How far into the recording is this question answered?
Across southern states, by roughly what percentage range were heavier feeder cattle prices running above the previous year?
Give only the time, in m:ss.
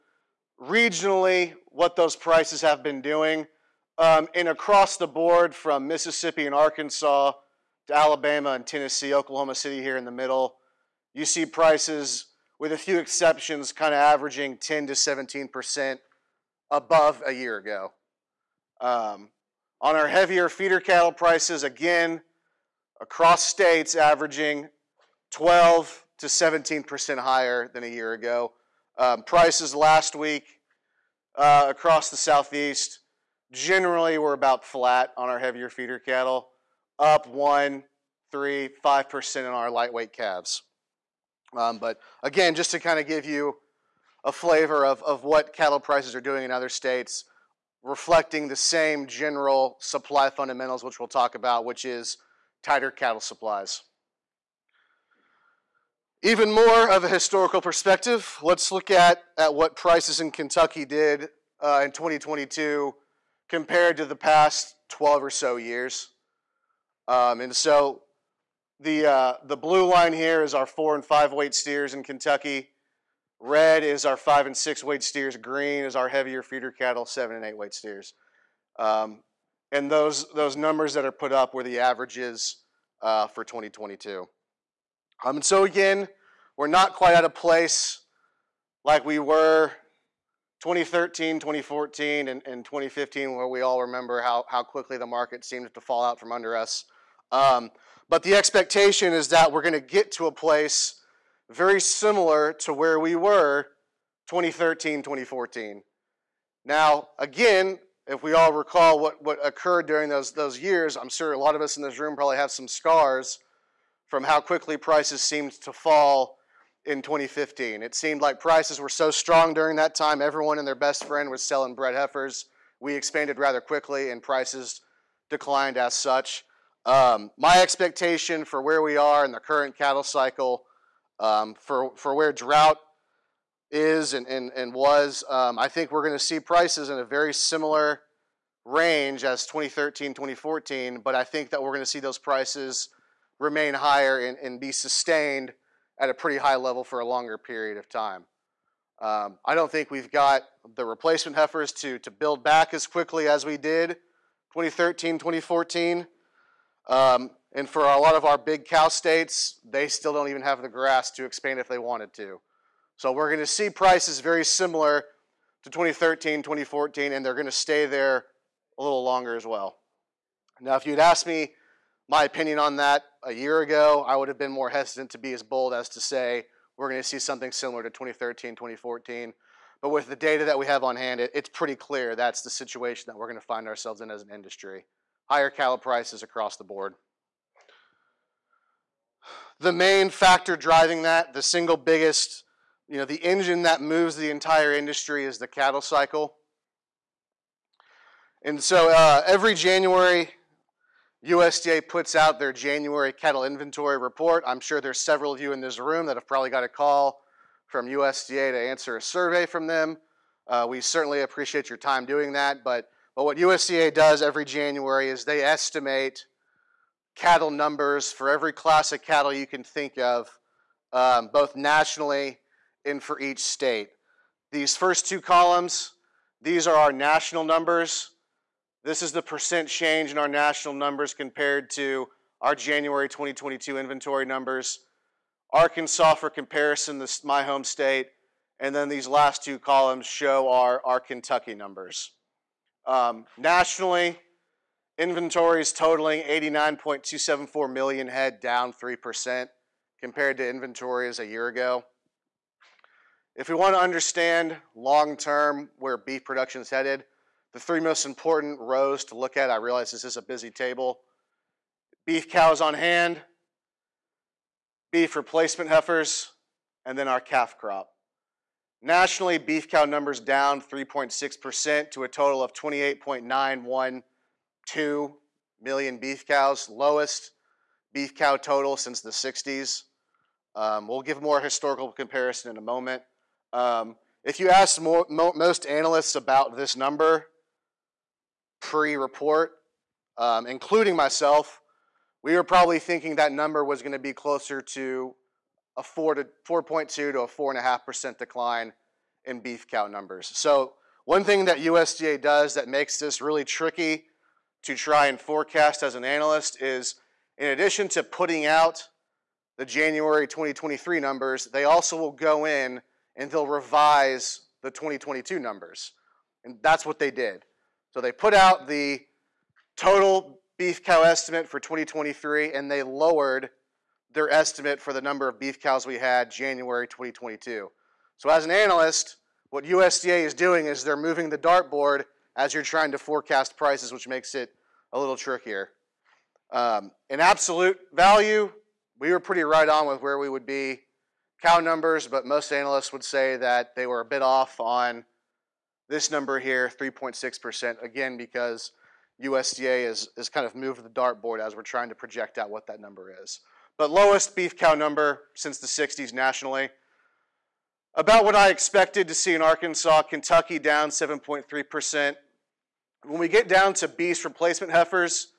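0:25.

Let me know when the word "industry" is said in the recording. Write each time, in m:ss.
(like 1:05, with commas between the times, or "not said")
3:04, 3:14.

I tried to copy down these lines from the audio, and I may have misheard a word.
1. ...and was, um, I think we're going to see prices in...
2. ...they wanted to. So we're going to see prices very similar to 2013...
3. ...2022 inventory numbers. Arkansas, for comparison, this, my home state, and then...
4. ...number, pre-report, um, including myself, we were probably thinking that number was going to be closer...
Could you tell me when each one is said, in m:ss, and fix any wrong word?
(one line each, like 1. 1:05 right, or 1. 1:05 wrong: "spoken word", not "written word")
1. 2:14 right
2. 2:41 right
3. 3:53 right
4. 4:46 right.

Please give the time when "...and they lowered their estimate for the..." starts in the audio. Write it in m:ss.
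5:22.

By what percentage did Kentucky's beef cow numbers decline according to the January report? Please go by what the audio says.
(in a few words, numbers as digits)
7.3%.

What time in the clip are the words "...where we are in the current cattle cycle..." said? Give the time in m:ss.
2:08.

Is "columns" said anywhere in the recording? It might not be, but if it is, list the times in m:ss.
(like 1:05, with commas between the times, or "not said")
3:45, 3:59.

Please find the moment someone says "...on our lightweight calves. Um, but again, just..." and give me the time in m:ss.
0:39.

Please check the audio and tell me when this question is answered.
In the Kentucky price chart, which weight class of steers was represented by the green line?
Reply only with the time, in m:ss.
1:17.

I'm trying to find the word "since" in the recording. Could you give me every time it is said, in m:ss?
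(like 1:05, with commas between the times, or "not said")
4:38, 5:55.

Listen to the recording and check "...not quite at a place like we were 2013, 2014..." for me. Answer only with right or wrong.
right.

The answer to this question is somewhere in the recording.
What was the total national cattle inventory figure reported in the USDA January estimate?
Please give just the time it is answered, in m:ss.
4:06.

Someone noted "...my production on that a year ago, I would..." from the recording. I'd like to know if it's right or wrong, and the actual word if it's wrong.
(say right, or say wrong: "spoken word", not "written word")
wrong: "opinion", not "production".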